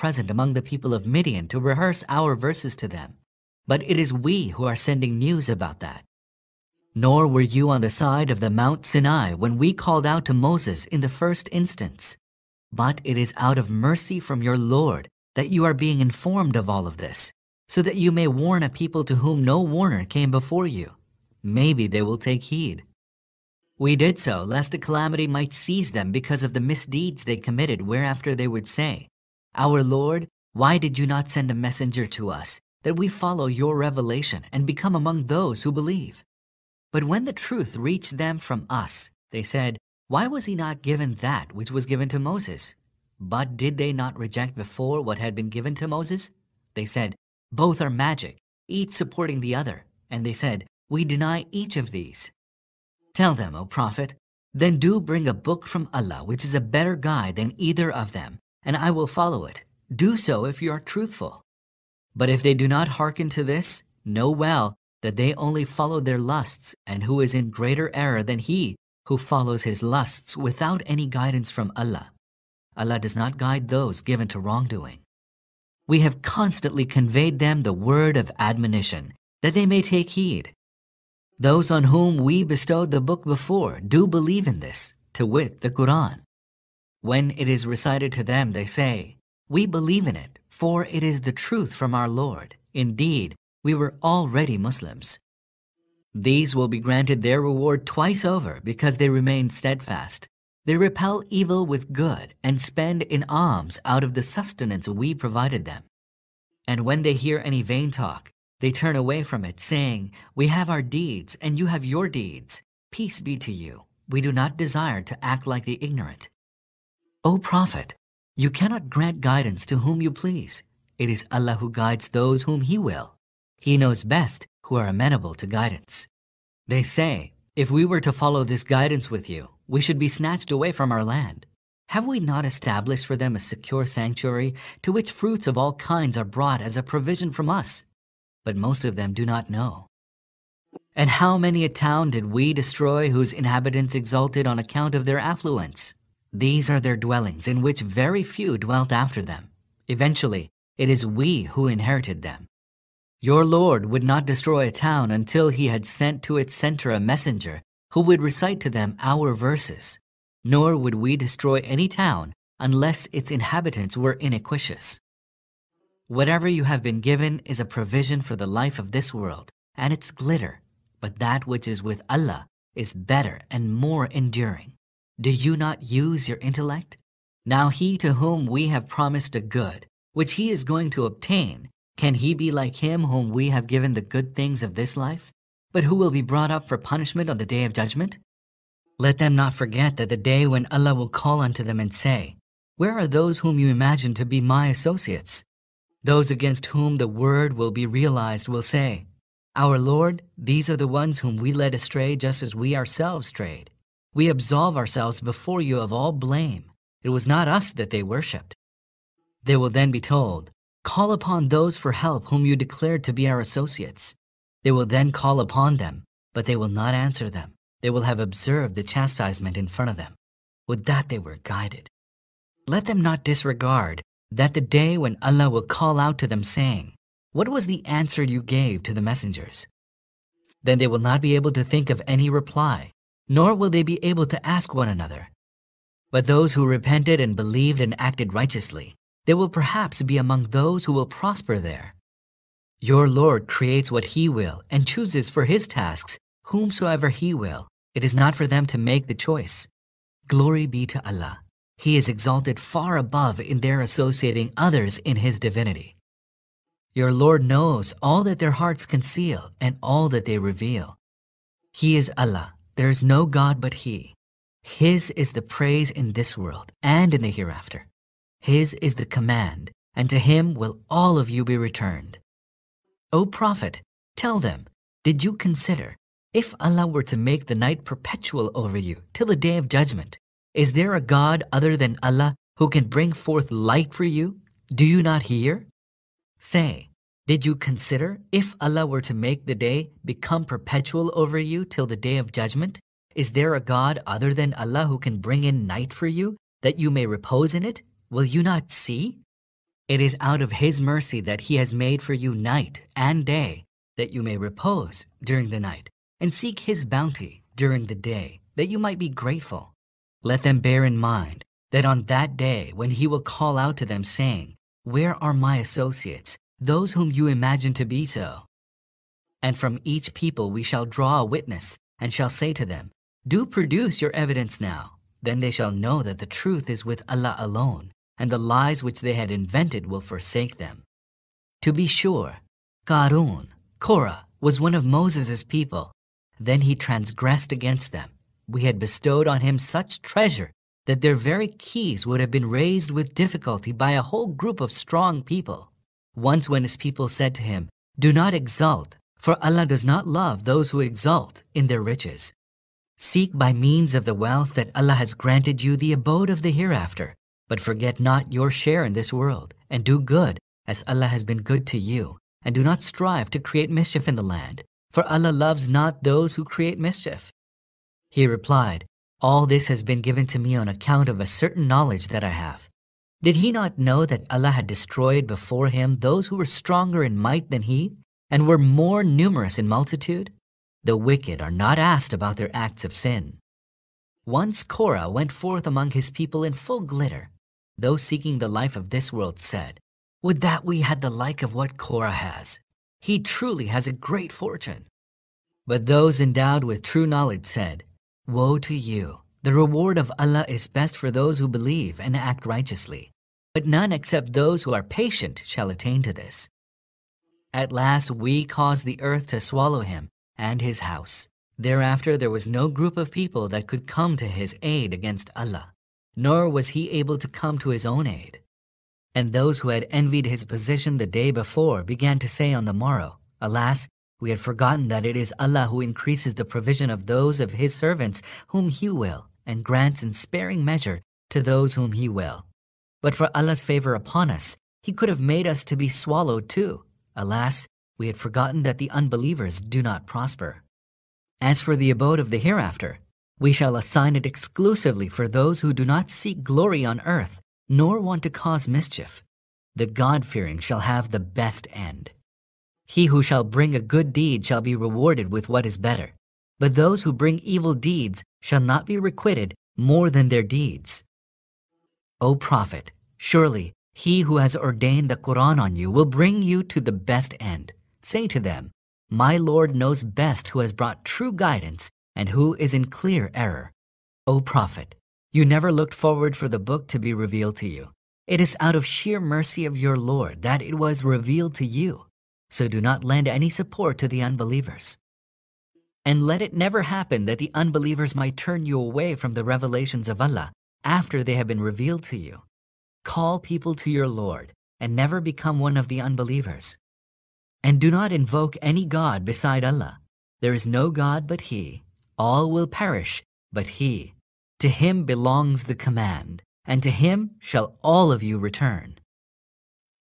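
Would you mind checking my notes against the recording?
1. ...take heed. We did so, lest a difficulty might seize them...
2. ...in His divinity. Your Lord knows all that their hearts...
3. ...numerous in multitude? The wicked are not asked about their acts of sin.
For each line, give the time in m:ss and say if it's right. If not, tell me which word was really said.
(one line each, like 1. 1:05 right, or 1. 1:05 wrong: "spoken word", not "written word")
1. 0:22 wrong: "calamity", not "difficulty"
2. 4:14 right
3. 6:19 right.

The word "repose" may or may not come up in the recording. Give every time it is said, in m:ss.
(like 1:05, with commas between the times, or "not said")
4:57, 5:04.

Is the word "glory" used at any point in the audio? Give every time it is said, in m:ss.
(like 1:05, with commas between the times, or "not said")
4:10, 7:26.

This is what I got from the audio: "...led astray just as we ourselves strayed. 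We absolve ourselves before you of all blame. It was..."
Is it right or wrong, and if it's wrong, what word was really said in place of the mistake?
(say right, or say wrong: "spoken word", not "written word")
right.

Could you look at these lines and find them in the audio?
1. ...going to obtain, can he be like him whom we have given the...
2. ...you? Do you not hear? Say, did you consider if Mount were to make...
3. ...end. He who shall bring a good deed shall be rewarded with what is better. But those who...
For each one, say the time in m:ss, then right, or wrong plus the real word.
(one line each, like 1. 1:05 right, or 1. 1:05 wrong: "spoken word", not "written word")
1. 3:00 right
2. 4:44 wrong: "Allah", not "Mount"
3. 7:31 right.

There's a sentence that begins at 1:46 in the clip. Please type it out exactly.
And when they hear any vain talk, they turn away from it, saying, We have our deeds, and you have your deeds.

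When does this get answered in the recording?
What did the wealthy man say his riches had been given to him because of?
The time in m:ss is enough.
6:11.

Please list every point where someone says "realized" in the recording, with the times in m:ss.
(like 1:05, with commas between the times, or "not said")
3:17.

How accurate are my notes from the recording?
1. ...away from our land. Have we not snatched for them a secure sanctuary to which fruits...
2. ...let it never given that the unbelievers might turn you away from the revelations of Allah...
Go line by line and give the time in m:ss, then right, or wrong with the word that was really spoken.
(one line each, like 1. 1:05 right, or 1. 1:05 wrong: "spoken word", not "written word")
1. 2:10 wrong: "established", not "snatched"
2. 8:06 wrong: "happen", not "given".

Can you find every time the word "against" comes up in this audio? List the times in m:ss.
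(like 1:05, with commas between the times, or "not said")
3:16, 5:37, 6:54.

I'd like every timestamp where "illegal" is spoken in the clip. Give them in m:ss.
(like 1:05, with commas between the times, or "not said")
not said.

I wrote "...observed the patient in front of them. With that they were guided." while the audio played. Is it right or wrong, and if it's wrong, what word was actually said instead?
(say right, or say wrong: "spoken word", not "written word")
wrong: "chastisement", not "patient".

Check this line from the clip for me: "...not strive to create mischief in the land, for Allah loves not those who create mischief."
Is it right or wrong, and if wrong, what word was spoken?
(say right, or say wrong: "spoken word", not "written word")
right.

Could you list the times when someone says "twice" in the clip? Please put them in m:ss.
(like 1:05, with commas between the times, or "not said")
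1:37.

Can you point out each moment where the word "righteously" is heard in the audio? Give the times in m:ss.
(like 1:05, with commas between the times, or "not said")
3:58, 6:42.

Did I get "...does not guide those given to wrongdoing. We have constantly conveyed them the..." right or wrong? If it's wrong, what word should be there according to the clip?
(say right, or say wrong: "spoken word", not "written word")
right.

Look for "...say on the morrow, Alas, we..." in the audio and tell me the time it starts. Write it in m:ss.
7:02.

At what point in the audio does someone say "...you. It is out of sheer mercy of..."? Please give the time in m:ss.
7:57.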